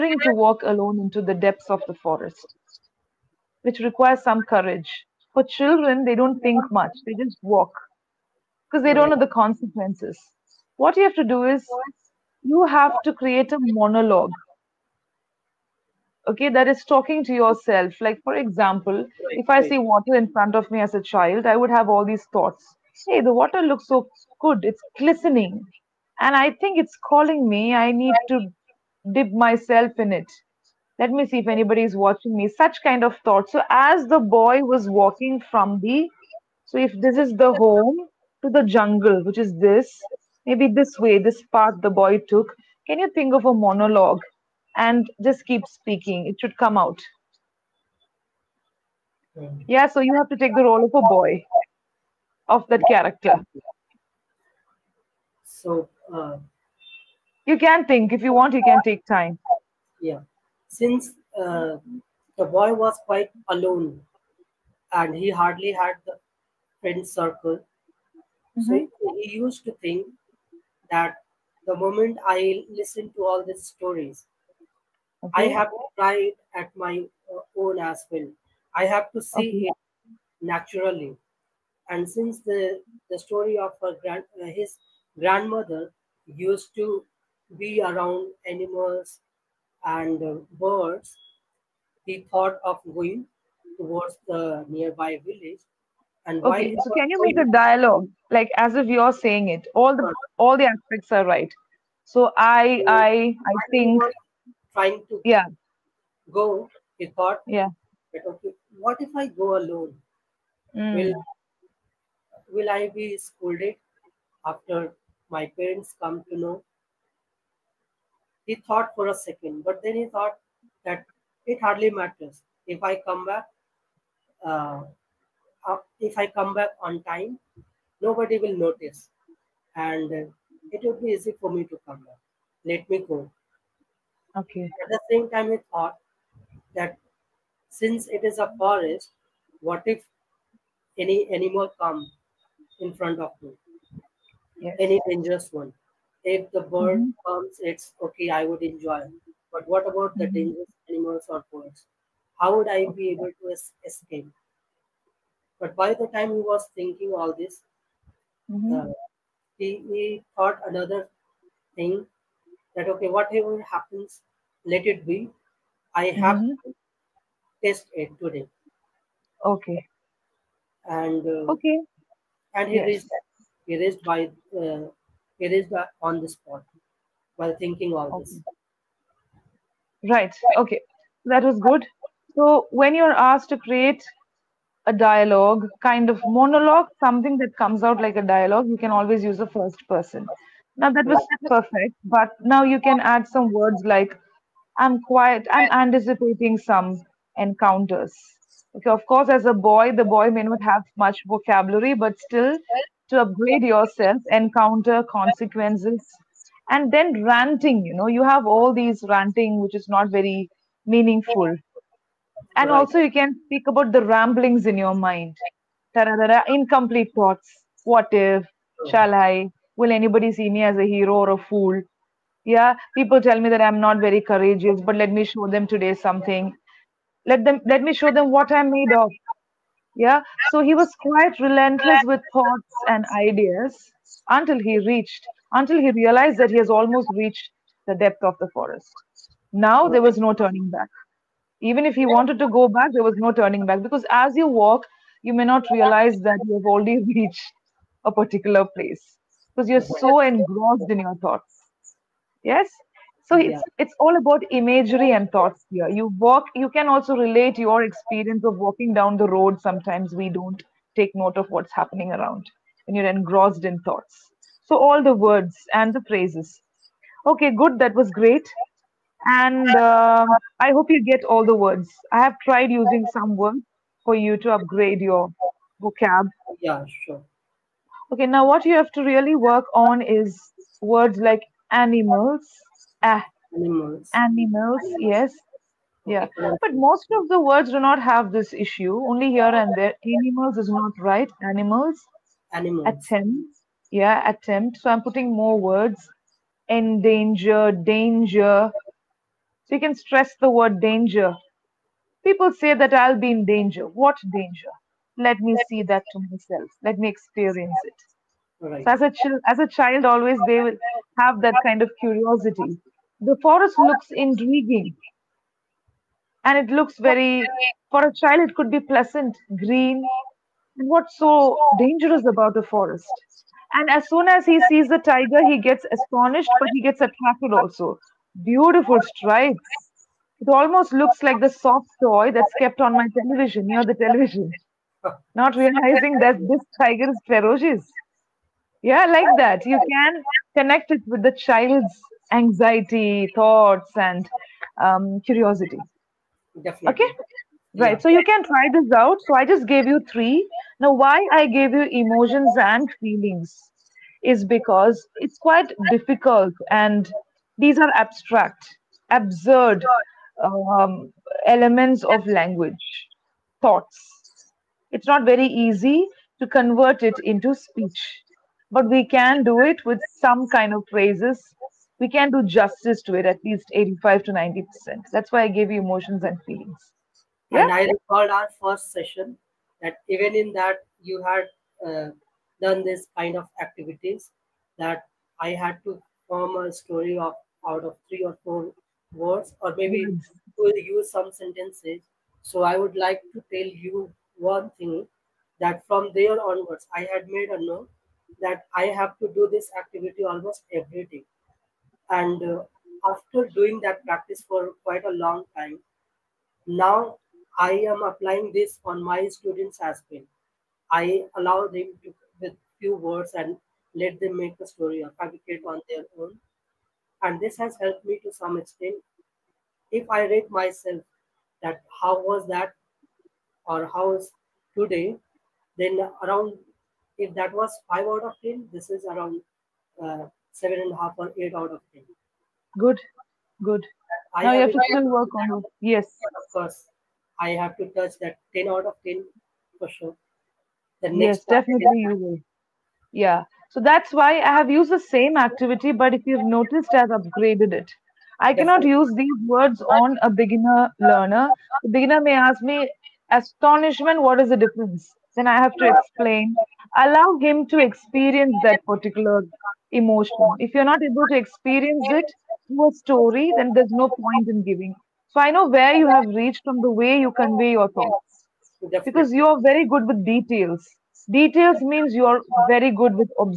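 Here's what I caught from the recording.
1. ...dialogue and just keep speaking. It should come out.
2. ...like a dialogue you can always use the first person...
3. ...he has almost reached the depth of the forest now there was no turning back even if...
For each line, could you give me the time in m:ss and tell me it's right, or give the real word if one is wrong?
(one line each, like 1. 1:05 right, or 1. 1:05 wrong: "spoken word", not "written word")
1. 0:43 wrong: "monologue", not "dialogue"
2. 3:08 right
3. 3:56 right.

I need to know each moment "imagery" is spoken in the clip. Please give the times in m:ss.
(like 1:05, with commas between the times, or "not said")
4:14.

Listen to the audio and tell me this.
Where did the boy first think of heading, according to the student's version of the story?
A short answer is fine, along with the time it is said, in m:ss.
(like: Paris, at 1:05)
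The nearby village, at 1:34.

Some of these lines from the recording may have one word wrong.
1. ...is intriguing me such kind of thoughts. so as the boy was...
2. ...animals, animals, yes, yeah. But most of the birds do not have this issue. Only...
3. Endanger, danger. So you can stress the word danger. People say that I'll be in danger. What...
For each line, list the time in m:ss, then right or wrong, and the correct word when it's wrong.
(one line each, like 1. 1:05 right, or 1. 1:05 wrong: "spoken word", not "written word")
1. 0:31 wrong: "watching", not "intriguing"
2. 4:43 wrong: "words", not "birds"
3. 4:56 right.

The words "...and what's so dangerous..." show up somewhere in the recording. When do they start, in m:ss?
5:20.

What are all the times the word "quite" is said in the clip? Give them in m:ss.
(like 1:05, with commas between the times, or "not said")
1:03, 3:51, 5:55, 6:44.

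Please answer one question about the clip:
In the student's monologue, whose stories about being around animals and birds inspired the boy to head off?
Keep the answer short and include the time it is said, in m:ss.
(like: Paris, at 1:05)
His grandmother, at 1:24.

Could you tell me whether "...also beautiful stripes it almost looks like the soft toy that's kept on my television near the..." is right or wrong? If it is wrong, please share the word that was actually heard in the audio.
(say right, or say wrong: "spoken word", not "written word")
right.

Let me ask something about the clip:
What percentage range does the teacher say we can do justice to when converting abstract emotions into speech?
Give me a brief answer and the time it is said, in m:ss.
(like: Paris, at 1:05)
85 to 90 percent, at 6:13.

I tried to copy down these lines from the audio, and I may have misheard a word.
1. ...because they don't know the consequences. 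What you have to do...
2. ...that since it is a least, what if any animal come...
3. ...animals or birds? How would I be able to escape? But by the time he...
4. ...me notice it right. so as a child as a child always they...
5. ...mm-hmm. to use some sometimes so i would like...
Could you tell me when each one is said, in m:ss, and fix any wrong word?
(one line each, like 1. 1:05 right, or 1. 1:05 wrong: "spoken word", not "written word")
1. 0:08 right
2. 2:16 wrong: "forest", not "least"
3. 2:30 right
4. 5:06 wrong: "experience", not "notice"
5. 6:30 wrong: "sentences", not "sometimes".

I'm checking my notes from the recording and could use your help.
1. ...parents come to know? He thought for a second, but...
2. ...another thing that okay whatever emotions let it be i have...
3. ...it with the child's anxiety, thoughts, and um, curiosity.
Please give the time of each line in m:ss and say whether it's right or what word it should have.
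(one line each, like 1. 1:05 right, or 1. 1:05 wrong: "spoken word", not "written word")
1. 1:55 right
2. 2:40 wrong: "happens", not "emotions"
3. 5:40 right.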